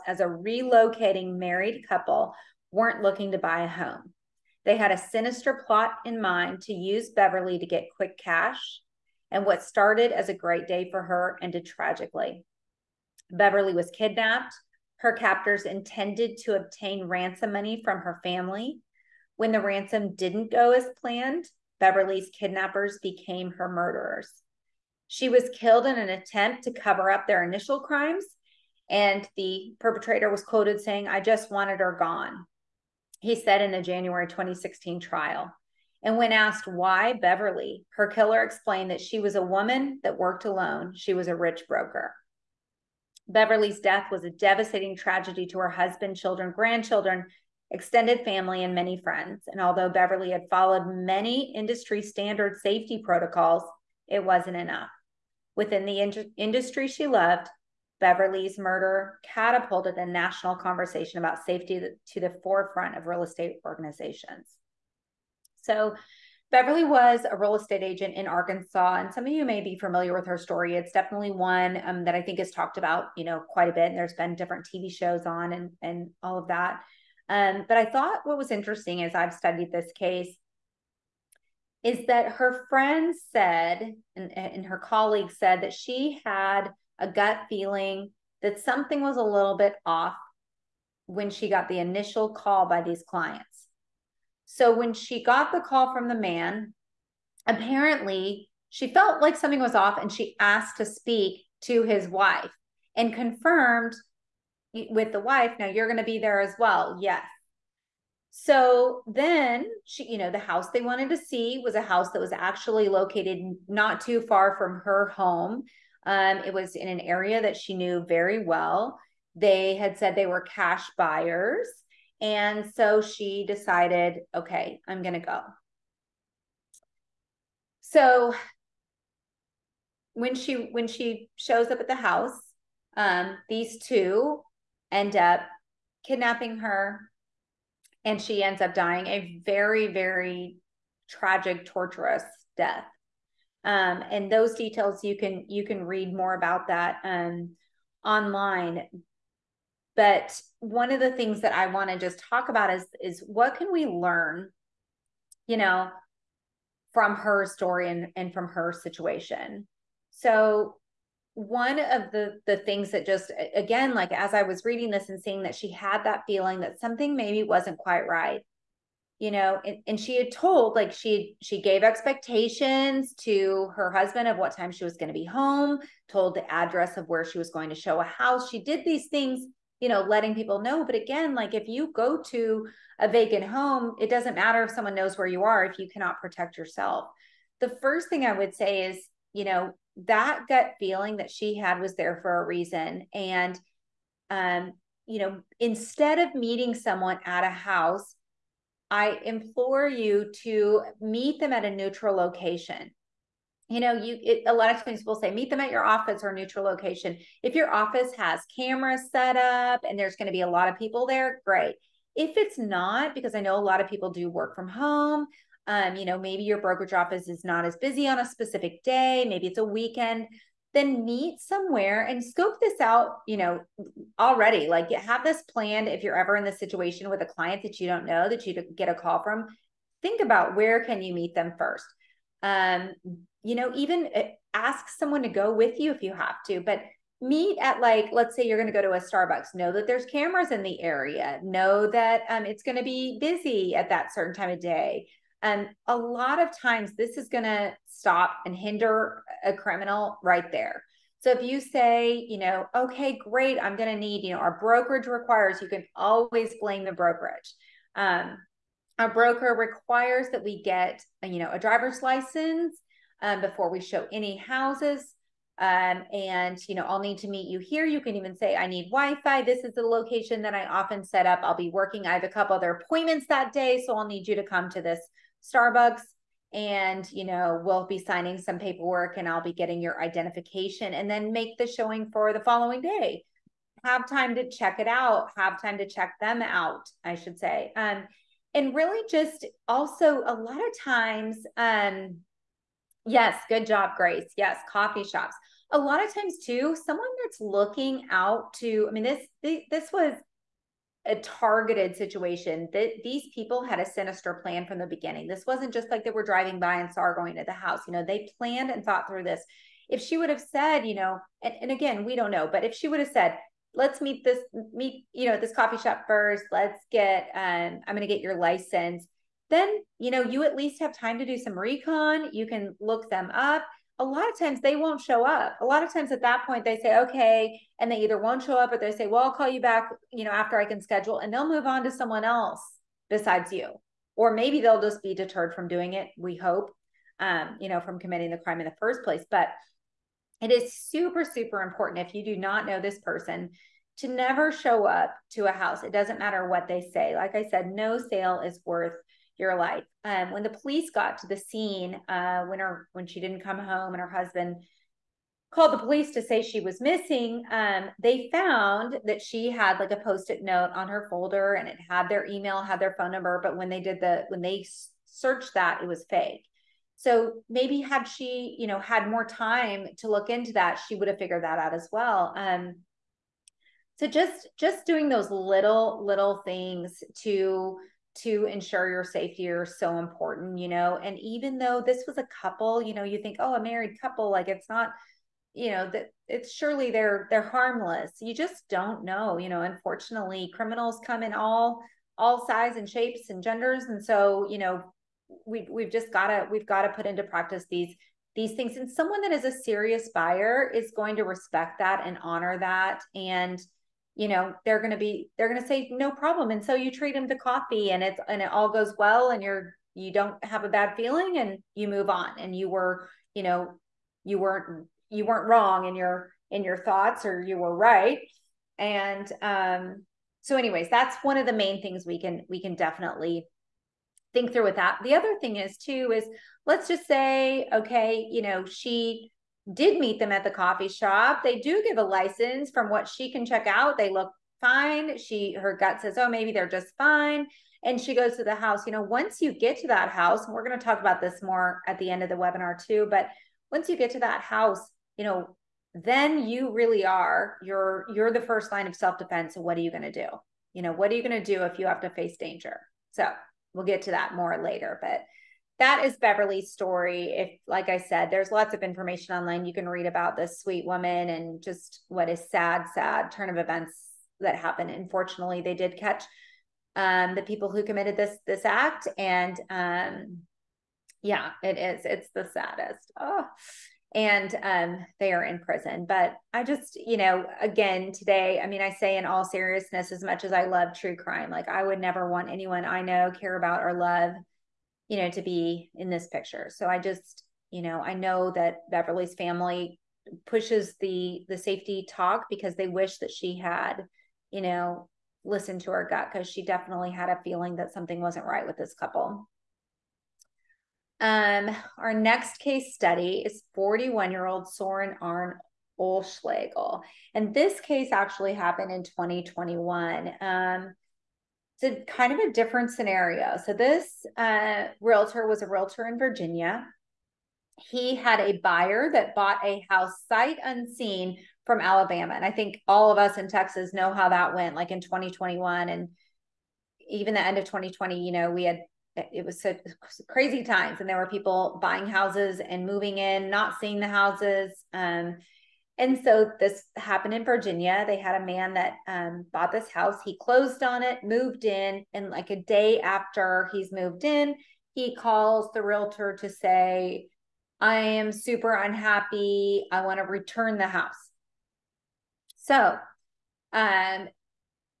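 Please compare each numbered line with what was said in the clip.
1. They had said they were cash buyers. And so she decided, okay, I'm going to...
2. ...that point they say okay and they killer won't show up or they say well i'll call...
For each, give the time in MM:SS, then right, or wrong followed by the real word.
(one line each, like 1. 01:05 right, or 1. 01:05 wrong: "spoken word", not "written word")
1. 01:59 right
2. 05:26 wrong: "either", not "killer".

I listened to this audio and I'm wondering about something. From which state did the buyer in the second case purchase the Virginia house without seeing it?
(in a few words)
Alabama.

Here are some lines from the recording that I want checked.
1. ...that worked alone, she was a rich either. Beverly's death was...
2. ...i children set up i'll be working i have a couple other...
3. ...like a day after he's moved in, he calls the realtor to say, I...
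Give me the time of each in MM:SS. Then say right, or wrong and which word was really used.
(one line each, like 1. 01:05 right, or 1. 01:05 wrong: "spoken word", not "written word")
1. 00:40 wrong: "broker", not "either"
2. 04:30 wrong: "often", not "children"
3. 09:02 right.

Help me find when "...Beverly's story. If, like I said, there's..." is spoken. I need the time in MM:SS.
07:36.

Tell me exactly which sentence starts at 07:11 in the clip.
They do give a license from what she can check out.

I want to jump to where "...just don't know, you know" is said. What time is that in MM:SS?
06:28.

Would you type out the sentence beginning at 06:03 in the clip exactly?
But when they did the when they searched that, it was fake.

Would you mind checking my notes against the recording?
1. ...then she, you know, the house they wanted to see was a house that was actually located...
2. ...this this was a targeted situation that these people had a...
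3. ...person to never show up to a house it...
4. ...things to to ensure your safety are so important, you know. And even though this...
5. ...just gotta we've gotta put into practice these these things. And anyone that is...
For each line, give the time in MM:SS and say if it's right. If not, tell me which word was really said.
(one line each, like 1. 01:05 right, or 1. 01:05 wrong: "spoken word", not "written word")
1. 01:49 right
2. 04:59 right
3. 05:42 right
4. 06:16 right
5. 06:35 wrong: "someone", not "anyone".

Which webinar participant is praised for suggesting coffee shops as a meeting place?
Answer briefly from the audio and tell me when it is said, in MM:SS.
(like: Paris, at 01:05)
Grace, at 04:53.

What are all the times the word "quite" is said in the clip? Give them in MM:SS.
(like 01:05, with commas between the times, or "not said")
01:13, 02:47.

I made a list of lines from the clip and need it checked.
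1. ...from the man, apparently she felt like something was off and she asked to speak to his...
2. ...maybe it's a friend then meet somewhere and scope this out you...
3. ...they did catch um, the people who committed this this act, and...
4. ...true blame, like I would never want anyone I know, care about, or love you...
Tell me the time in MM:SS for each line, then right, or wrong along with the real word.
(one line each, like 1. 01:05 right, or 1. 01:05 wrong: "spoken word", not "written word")
1. 01:35 right
2. 03:39 wrong: "weekend", not "friend"
3. 07:45 right
4. 08:00 wrong: "crime", not "blame".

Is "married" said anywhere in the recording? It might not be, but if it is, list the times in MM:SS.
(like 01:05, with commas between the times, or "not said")
00:01, 06:23.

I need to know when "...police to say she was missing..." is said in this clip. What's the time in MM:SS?
05:55.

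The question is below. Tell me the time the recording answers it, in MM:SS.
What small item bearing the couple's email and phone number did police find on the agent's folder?
05:59.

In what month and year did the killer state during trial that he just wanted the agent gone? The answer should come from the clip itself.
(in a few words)
January 2016.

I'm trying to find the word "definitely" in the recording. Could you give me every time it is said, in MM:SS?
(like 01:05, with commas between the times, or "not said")
01:10, 07:02, 08:16.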